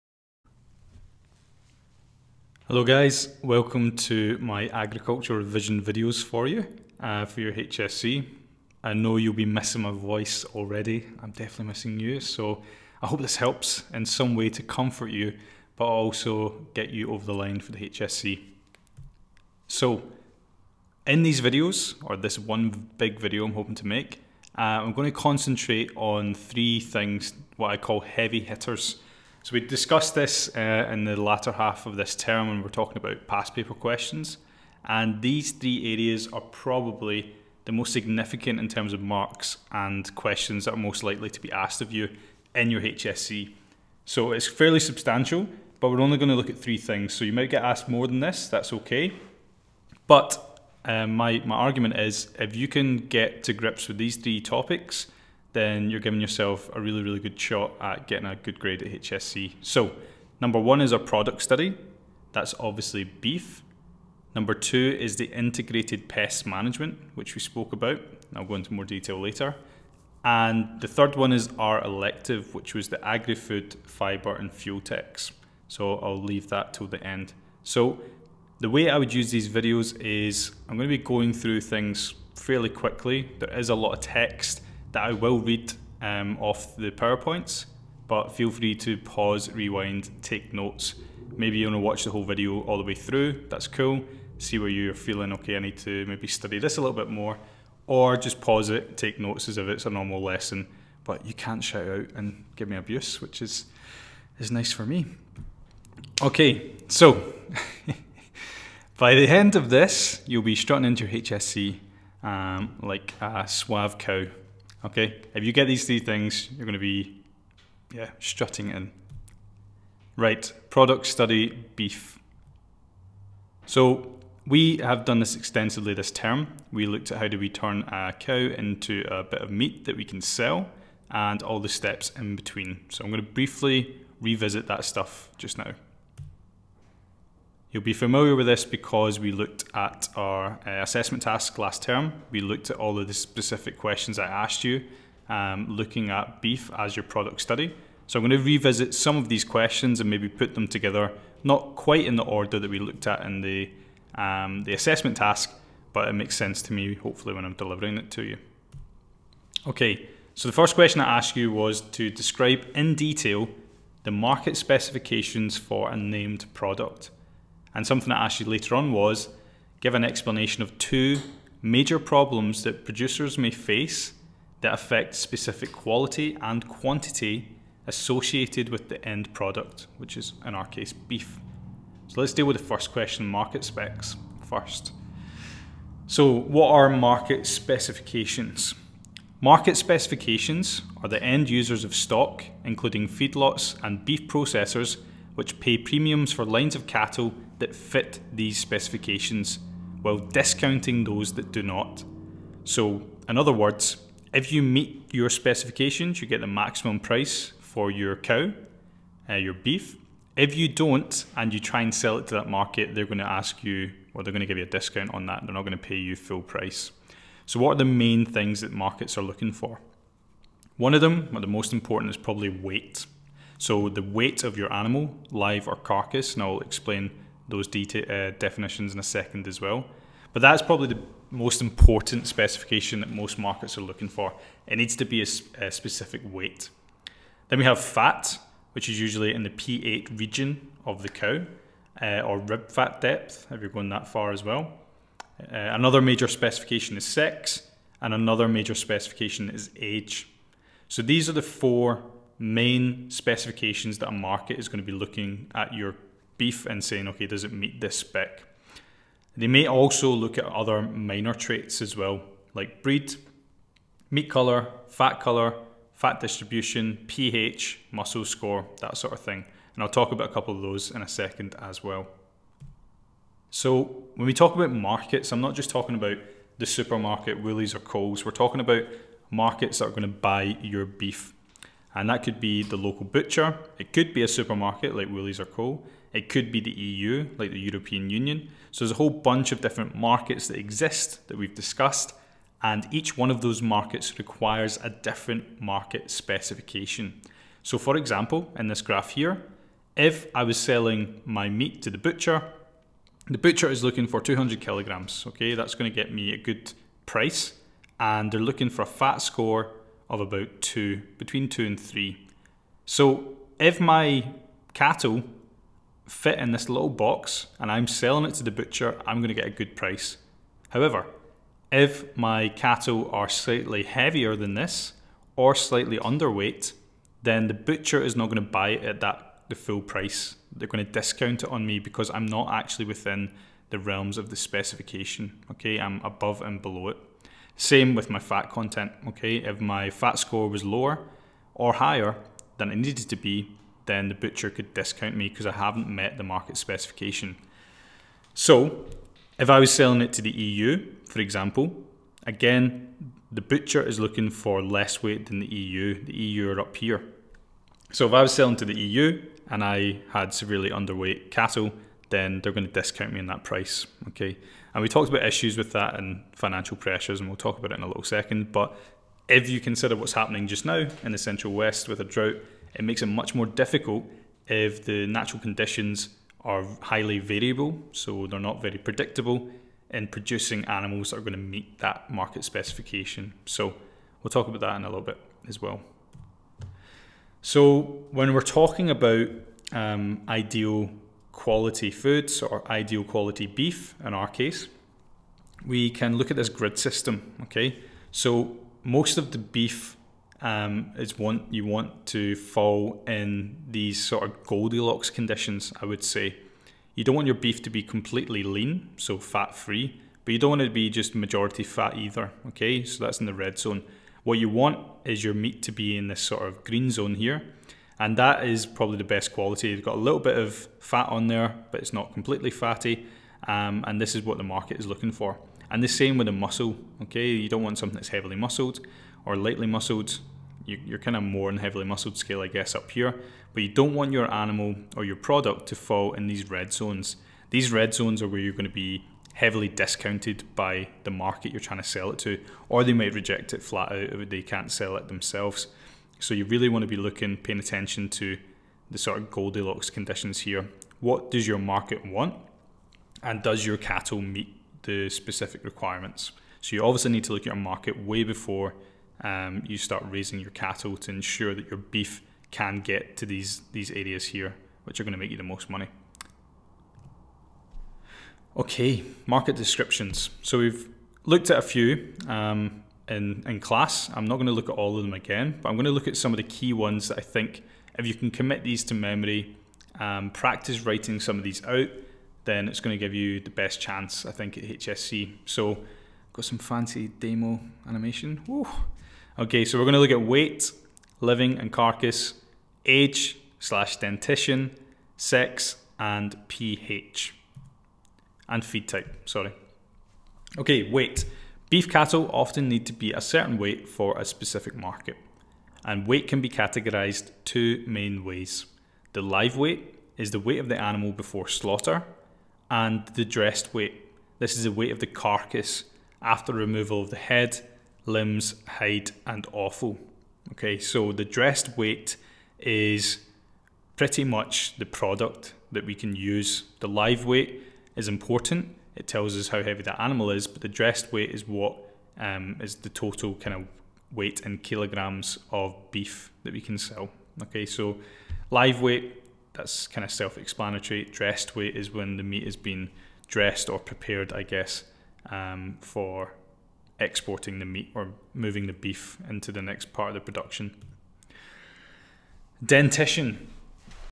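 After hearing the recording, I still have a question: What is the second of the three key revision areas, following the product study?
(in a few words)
integrated pest management.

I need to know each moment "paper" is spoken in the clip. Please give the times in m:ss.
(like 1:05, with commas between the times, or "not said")
0:33.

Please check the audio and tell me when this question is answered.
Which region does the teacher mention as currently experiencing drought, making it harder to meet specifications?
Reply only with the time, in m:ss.
6:11.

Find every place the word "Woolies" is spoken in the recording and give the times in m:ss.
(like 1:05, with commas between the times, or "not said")
4:37, 4:45.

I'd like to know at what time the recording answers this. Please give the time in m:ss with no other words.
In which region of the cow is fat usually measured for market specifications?
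3:59.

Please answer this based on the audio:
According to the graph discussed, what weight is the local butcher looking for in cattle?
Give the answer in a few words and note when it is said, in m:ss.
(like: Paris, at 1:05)
200 kilograms, at 5:04.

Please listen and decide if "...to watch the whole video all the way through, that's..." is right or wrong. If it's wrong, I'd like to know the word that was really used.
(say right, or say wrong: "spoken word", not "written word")
right.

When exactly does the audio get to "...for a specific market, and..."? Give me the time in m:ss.
8:23.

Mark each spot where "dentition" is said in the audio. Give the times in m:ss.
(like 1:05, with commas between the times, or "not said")
8:13, 9:12.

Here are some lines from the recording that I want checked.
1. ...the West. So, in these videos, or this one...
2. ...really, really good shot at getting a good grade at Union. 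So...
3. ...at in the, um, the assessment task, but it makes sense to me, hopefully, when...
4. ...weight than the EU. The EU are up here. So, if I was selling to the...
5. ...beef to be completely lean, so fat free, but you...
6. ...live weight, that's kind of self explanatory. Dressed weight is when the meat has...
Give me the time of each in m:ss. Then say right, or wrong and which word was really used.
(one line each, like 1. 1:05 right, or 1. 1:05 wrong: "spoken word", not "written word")
1. 0:17 wrong: "HSC", not "West"
2. 0:56 wrong: "HSC", not "Union"
3. 2:33 right
4. 5:55 right
5. 6:47 right
6. 8:58 right.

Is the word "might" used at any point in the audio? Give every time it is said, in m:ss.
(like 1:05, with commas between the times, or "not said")
0:47, 7:22.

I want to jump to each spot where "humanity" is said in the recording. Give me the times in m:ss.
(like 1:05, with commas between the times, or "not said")
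not said.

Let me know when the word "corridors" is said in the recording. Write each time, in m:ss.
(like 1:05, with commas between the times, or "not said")
not said.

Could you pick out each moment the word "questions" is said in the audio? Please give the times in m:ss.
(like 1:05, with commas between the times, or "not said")
0:33, 0:40, 2:23, 2:29, 2:40, 3:02.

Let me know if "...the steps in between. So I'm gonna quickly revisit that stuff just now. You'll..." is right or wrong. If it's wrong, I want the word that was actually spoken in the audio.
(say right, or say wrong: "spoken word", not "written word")
wrong: "briefly", not "quickly".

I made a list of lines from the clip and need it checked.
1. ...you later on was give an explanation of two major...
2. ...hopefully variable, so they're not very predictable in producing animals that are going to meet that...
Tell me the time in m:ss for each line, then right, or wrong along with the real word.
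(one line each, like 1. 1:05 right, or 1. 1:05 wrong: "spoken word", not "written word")
1. 2:48 right
2. 6:16 wrong: "highly", not "hopefully".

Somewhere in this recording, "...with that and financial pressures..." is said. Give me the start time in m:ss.
6:05.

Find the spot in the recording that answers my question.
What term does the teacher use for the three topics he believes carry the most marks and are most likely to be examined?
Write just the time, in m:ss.
0:27.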